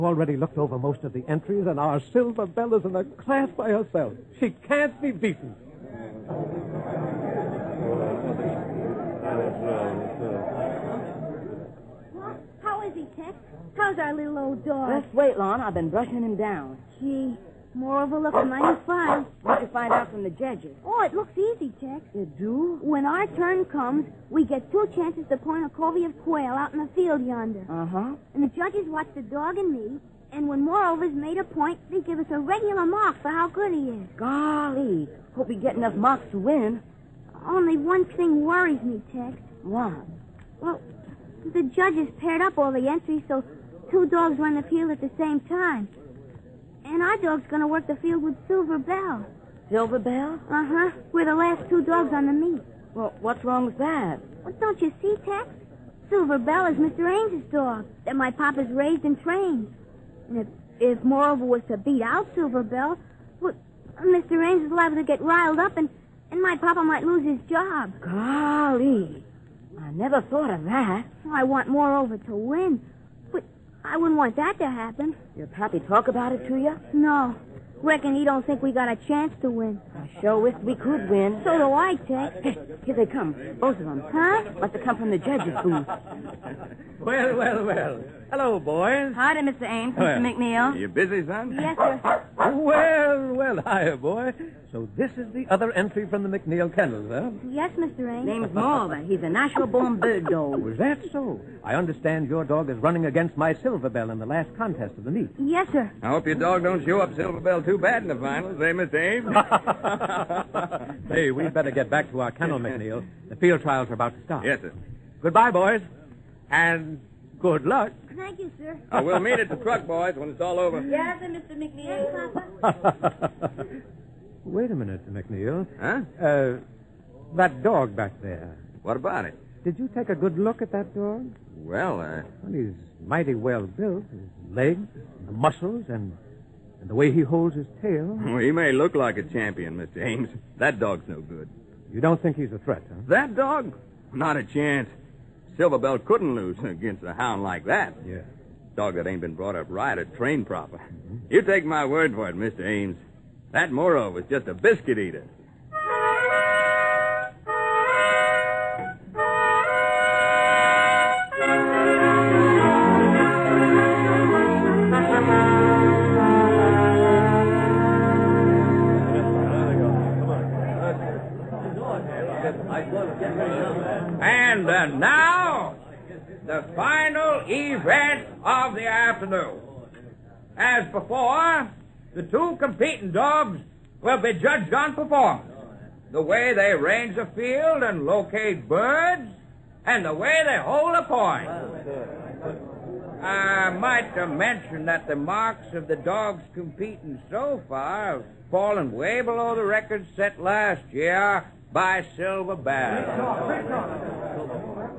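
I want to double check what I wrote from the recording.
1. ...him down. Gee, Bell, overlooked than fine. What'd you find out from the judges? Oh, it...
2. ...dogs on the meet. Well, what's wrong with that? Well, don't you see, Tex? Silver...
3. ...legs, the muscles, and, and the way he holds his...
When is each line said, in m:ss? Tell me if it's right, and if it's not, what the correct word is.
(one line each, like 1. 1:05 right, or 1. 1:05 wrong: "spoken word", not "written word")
1. 0:16 wrong: "Moreover", not "Bell"
2. 0:51 right
3. 2:14 right.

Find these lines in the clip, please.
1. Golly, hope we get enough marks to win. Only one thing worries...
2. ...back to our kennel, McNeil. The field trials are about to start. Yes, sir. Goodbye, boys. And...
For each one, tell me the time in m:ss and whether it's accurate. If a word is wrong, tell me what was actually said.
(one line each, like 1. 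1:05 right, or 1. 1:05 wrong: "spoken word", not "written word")
1. 0:34 right
2. 1:51 right.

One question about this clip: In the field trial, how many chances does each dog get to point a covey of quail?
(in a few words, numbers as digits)
2.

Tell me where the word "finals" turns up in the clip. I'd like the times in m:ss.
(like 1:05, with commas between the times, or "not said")
1:48, 2:56.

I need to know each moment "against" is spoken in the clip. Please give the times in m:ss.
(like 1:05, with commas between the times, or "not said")
1:43, 2:26.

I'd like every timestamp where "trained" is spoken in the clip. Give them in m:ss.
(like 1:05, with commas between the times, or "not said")
0:59, 2:30.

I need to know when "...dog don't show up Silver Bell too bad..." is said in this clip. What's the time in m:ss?
1:46.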